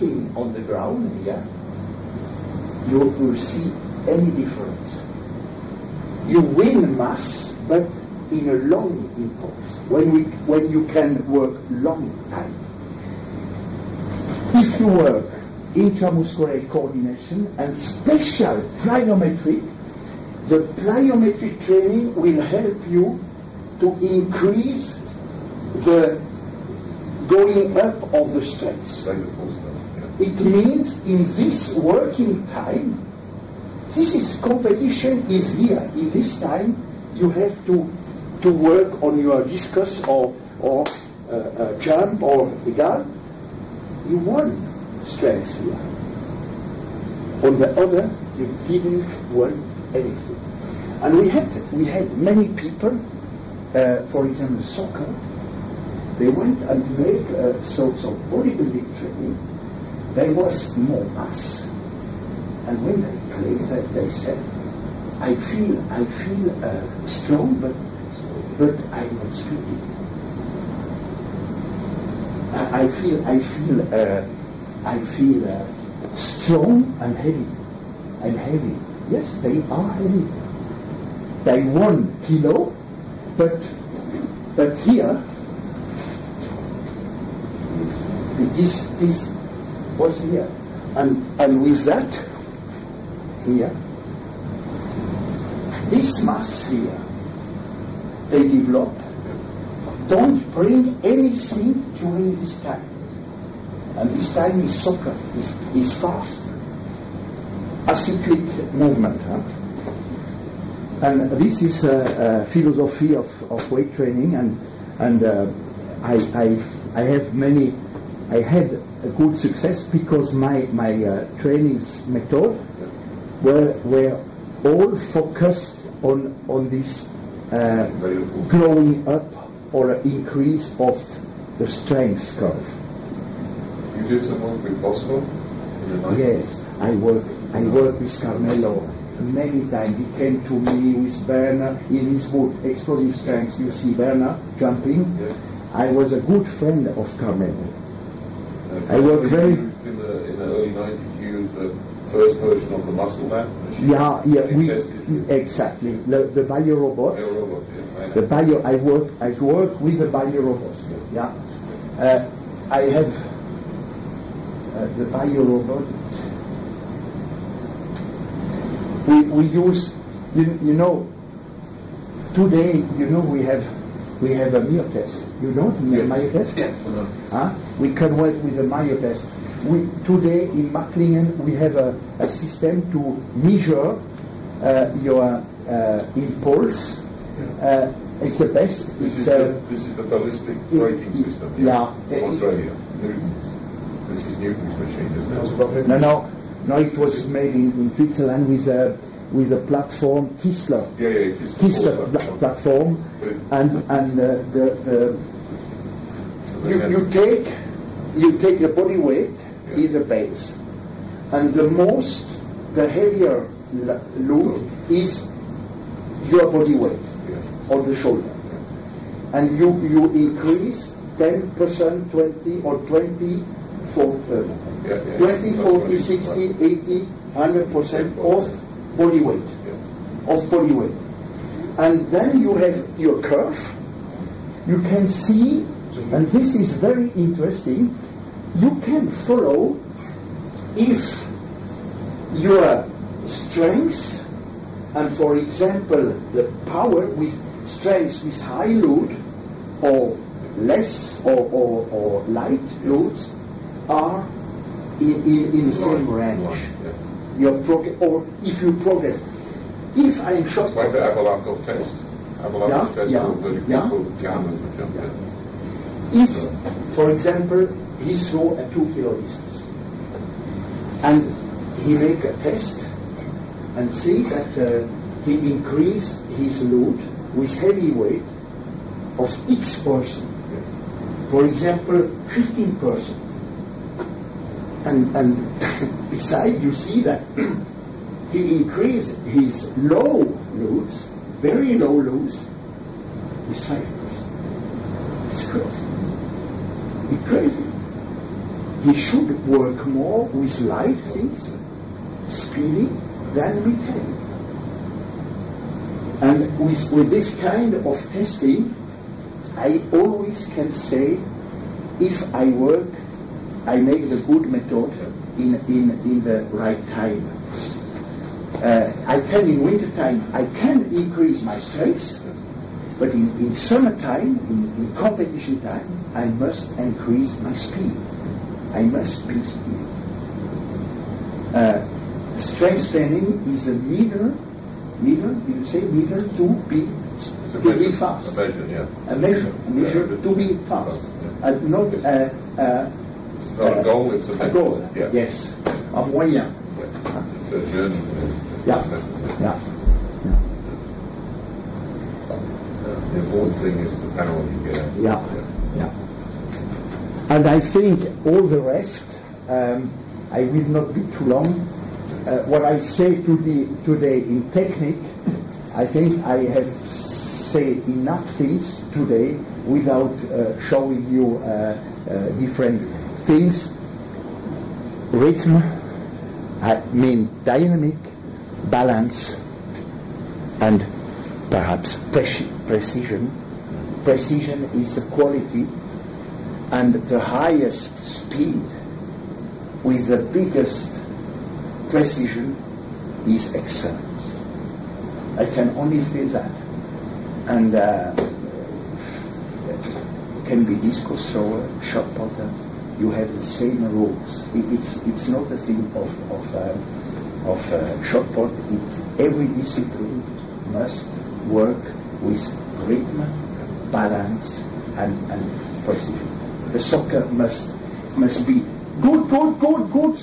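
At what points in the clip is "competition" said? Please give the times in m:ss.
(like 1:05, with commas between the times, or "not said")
0:34, 5:24.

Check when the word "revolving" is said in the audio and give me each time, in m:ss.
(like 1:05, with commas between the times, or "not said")
not said.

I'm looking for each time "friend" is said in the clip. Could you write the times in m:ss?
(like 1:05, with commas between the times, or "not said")
2:26.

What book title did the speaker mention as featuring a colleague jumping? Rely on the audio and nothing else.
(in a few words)
Explosive Strengths.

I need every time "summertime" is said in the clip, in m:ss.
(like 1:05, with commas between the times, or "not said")
5:23.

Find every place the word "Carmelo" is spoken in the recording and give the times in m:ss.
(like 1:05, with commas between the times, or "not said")
2:18, 2:27.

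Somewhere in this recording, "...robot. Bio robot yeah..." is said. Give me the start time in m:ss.
2:36.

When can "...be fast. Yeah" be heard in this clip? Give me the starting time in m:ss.
5:40.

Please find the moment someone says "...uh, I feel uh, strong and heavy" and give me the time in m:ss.
1:13.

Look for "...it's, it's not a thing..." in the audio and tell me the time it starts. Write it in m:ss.
6:44.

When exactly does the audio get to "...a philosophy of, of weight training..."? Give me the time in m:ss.
1:52.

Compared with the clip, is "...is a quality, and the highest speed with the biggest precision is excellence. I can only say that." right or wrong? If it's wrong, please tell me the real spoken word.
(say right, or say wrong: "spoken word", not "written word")
right.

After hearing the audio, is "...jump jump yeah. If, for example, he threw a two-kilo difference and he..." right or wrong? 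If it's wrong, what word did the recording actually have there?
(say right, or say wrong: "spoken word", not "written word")
wrong: "distance", not "difference".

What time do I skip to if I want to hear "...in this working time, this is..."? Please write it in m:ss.
0:31.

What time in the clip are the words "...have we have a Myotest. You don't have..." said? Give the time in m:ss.
2:53.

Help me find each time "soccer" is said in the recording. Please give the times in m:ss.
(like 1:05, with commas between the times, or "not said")
0:54, 1:44, 6:56.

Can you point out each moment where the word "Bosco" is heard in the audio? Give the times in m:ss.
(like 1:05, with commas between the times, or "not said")
2:14.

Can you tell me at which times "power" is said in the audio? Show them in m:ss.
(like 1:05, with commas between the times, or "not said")
4:06, 5:54.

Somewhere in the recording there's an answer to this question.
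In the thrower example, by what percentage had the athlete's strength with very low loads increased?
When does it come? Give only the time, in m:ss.
4:53.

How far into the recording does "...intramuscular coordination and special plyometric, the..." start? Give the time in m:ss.
0:15.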